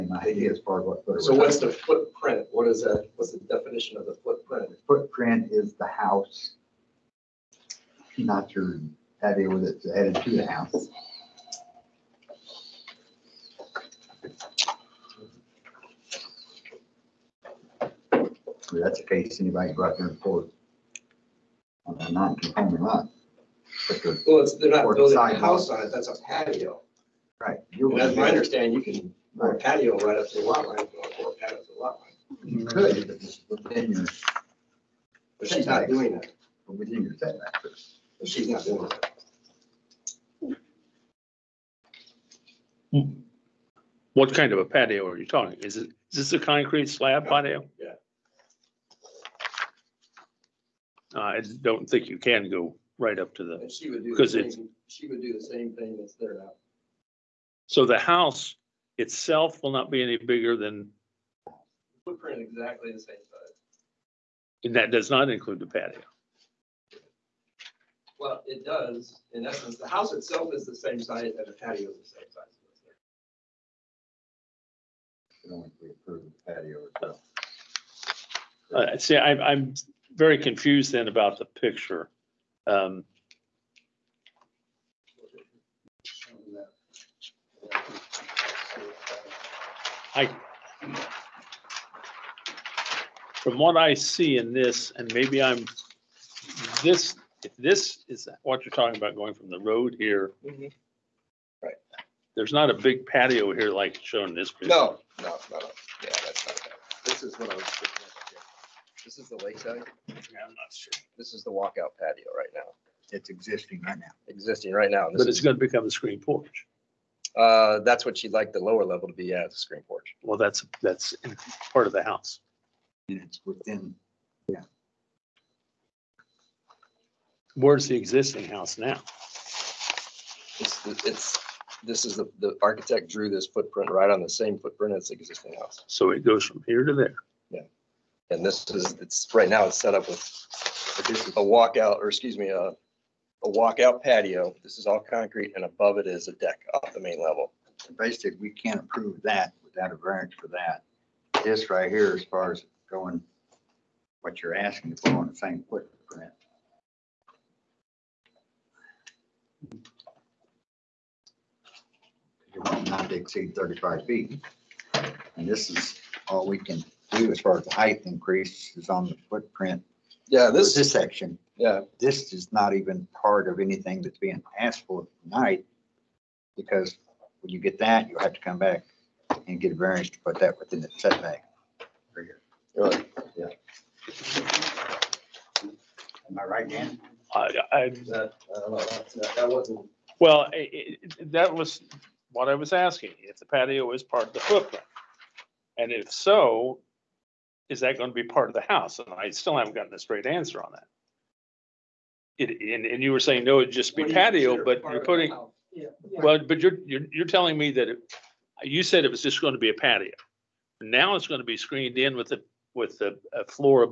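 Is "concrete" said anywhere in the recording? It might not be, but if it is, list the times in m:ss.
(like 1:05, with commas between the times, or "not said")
0:46, 2:24.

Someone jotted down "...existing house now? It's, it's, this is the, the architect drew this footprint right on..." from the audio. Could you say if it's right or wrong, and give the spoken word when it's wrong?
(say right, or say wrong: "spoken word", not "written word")
right.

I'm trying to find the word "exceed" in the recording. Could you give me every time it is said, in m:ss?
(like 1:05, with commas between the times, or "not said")
2:43.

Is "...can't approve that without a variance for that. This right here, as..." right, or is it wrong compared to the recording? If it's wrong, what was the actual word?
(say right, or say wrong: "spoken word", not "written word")
right.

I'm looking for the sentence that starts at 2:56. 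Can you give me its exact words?
Because when you get that, you'll have to come back and get a variance to put that within the setback.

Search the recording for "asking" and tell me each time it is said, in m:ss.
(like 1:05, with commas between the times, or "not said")
2:34, 3:12.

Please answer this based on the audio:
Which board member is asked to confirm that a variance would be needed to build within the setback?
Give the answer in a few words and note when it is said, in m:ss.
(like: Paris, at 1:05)
Dan, at 3:06.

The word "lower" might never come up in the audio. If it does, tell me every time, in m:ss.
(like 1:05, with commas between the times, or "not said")
1:58.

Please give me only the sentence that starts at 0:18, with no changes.
That's the case, anybody go out there and pour on a non-conforming lot.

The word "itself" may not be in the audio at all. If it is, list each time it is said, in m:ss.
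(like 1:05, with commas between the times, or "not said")
0:58, 1:10, 1:16.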